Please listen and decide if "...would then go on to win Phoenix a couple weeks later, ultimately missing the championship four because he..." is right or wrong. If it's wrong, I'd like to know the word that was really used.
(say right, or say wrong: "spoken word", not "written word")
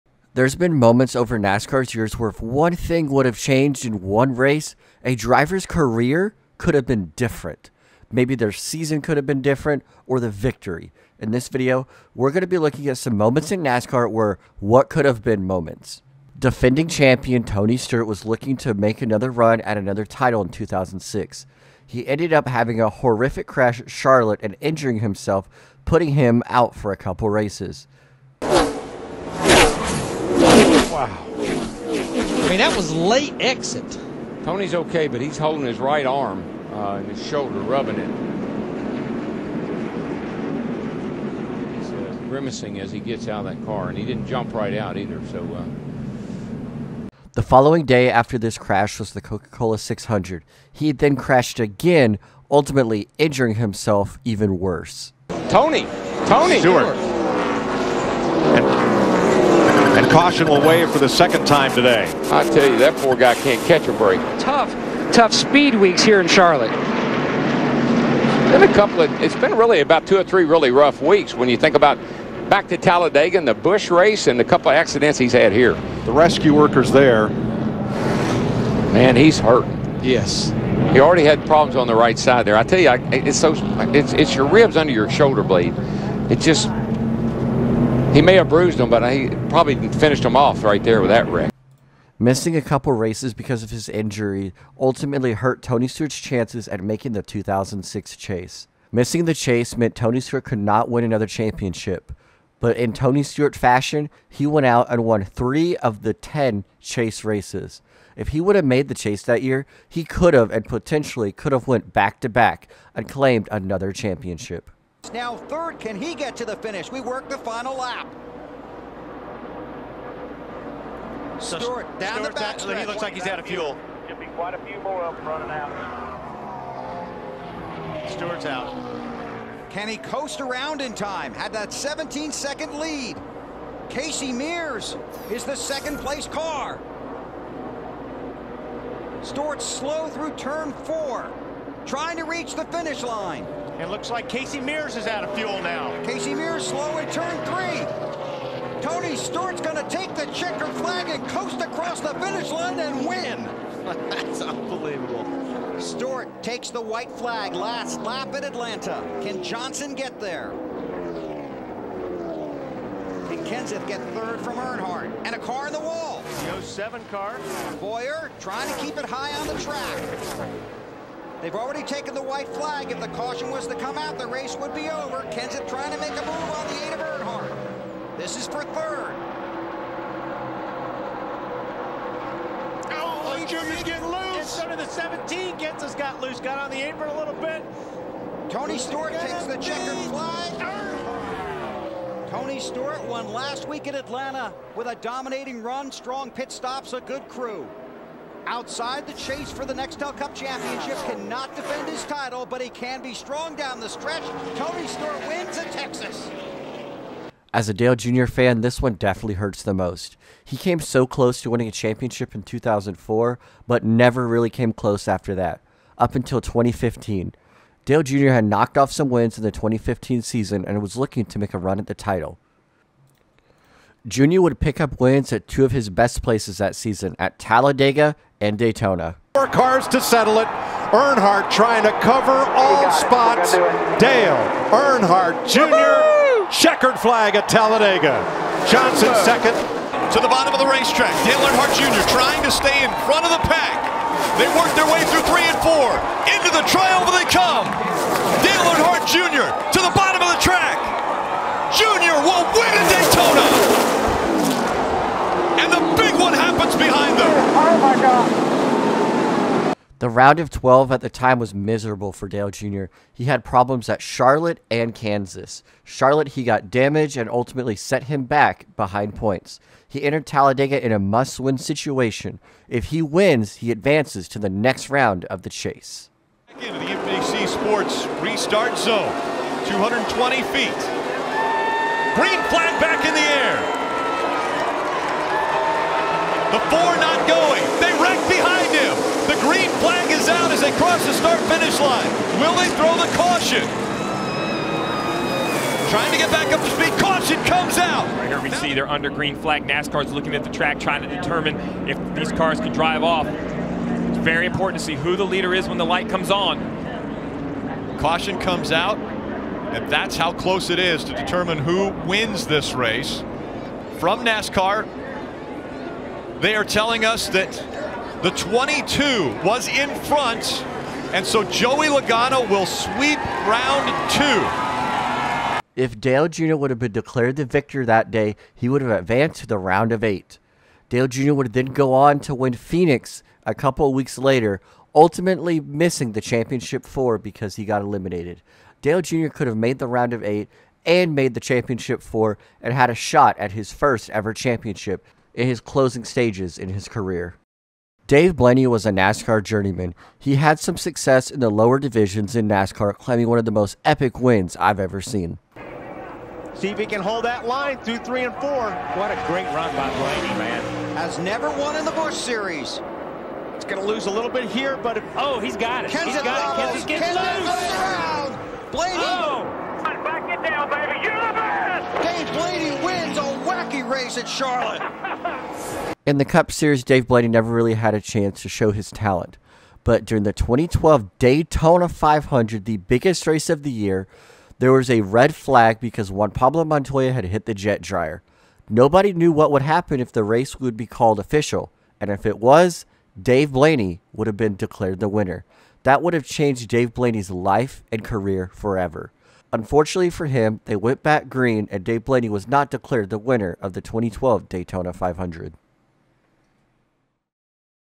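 right.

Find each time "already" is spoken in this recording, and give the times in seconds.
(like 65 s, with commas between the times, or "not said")
80 s, 171 s.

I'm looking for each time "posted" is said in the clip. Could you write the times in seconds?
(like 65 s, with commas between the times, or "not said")
not said.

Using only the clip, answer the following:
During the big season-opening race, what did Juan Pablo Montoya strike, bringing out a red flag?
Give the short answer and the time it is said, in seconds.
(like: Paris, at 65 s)
The jet dryer, at 387 s.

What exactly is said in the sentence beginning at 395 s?
That would have changed Dave Blaney's life and career forever.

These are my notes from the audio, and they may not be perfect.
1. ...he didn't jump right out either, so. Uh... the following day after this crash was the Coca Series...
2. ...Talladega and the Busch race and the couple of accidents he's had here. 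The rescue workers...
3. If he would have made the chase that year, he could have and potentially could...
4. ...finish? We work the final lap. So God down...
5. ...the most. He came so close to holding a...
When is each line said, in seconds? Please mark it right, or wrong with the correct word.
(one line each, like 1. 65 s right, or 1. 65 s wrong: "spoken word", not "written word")
1. 43 s wrong: "Cola", not "Series"
2. 72 s right
3. 108 s right
4. 116 s wrong: "Stewart", not "God"
5. 209 s wrong: "winning", not "holding".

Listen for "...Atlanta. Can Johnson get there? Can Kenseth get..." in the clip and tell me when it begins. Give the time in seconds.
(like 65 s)
158 s.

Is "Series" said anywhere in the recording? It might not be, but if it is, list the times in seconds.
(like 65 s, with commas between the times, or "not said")
362 s, 376 s.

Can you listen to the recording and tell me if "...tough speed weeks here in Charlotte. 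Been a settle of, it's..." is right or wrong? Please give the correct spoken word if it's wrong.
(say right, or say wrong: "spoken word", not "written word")
wrong: "couple", not "settle".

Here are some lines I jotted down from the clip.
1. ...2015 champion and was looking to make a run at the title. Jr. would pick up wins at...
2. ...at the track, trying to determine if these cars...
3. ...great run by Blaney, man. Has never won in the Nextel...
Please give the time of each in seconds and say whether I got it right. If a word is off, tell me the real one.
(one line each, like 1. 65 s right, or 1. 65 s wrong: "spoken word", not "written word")
1. 219 s wrong: "season", not "champion"
2. 300 s right
3. 359 s wrong: "Busch", not "Nextel".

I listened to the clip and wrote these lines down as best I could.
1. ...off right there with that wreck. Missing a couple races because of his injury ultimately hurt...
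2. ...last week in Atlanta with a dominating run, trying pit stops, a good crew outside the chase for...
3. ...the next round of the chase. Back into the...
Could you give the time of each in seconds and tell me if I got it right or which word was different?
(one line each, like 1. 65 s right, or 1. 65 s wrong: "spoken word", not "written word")
1. 90 s right
2. 193 s wrong: "strong", not "trying"
3. 274 s right.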